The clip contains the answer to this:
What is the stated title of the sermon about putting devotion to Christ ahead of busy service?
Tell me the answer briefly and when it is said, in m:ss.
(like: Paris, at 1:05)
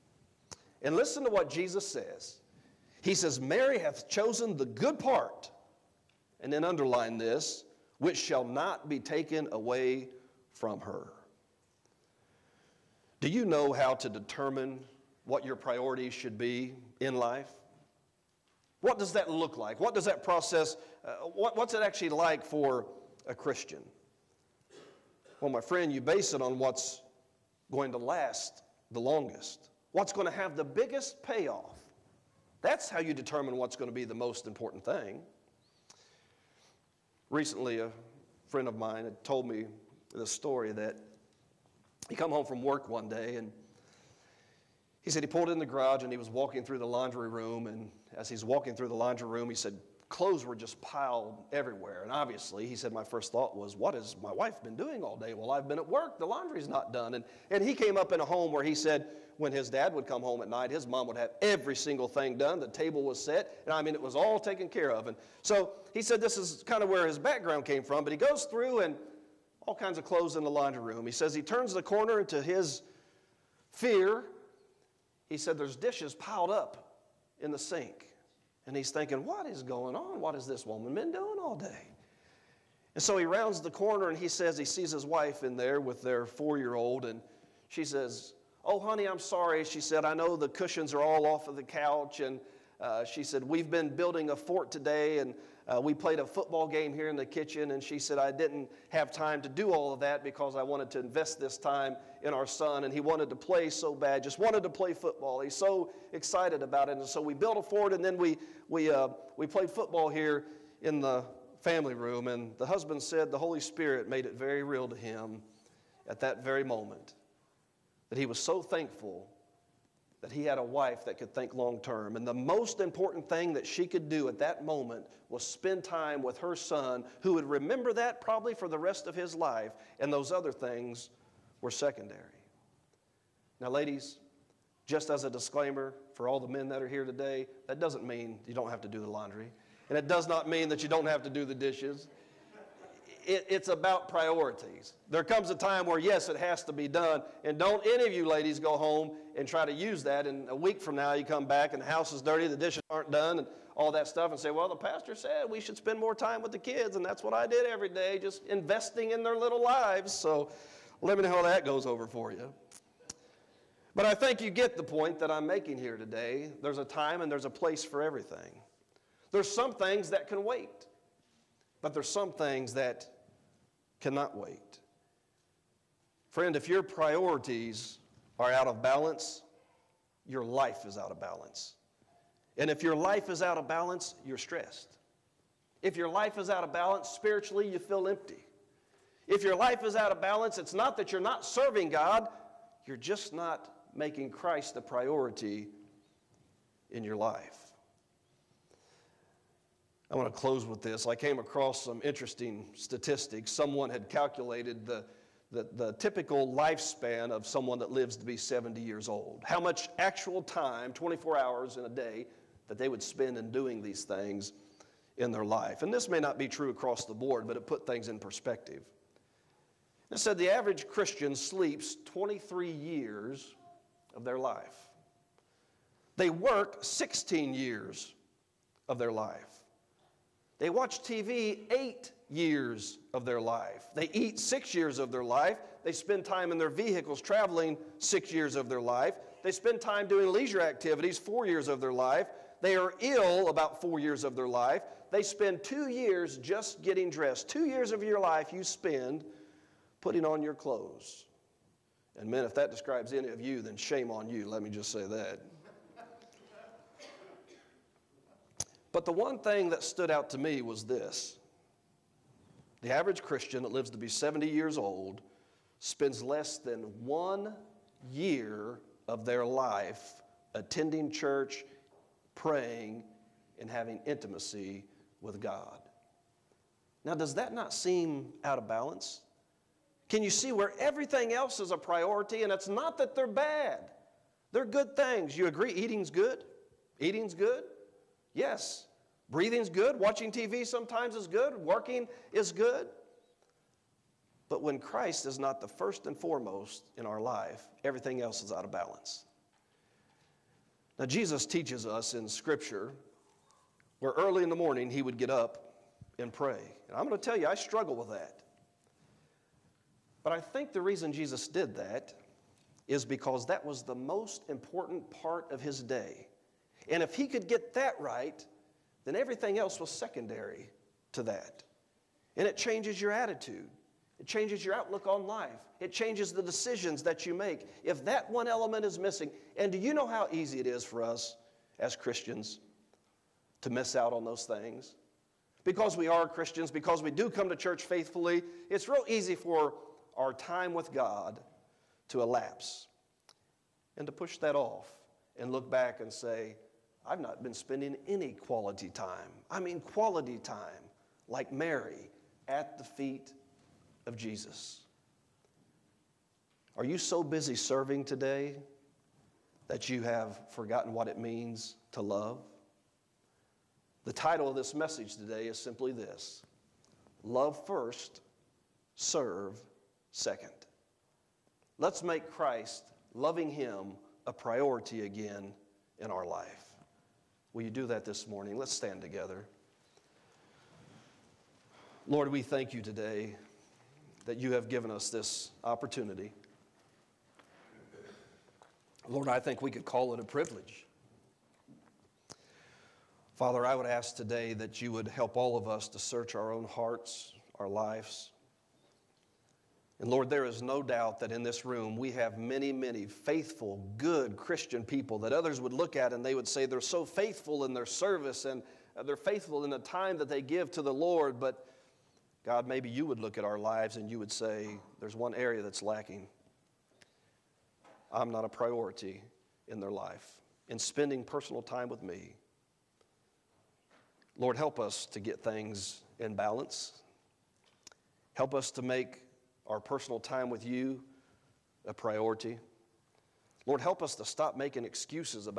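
Love first, serve second, at 6:07.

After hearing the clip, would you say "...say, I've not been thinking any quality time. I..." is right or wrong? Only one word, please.
wrong.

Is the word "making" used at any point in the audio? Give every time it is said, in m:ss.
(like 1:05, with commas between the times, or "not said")
2:45, 3:13, 7:14.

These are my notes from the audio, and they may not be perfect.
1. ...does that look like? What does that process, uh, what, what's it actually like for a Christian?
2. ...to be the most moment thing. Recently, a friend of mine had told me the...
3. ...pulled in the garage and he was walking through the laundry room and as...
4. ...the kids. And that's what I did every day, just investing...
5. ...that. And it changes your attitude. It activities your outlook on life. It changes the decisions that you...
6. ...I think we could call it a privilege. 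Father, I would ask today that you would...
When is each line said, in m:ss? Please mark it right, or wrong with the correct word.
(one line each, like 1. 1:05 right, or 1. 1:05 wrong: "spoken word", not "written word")
1. 0:18 right
2. 0:33 wrong: "important", not "moment"
3. 0:45 right
4. 2:36 right
5. 5:21 wrong: "changes", not "activities"
6. 6:29 right.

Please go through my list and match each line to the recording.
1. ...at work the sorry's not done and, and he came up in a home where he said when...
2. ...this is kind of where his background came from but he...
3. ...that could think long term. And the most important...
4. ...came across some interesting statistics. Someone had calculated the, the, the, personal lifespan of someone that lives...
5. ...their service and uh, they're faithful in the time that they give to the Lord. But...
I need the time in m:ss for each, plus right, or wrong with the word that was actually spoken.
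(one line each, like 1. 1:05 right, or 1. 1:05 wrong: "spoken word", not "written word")
1. 0:55 wrong: "laundry", not "sorry"
2. 1:06 right
3. 2:01 right
4. 3:21 wrong: "typical", not "personal"
5. 6:47 right.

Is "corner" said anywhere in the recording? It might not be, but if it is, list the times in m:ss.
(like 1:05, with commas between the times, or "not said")
1:11, 1:23.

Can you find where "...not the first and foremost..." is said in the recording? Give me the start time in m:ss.
4:55.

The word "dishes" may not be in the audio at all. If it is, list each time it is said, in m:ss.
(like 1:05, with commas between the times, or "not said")
1:15, 2:21, 2:32.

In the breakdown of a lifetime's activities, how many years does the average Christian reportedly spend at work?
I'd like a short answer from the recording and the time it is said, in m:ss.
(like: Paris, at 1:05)
16, at 3:46.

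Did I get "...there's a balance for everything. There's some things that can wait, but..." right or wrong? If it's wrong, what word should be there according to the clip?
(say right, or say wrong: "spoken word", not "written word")
wrong: "place", not "balance".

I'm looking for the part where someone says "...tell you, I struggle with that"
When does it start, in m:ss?
5:07.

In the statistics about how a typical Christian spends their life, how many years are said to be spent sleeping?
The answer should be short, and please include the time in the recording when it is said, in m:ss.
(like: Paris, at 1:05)
23, at 3:42.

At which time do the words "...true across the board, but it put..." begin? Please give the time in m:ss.
3:36.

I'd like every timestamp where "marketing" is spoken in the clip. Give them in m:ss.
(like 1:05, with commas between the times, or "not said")
not said.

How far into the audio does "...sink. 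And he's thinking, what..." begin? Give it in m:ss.
1:17.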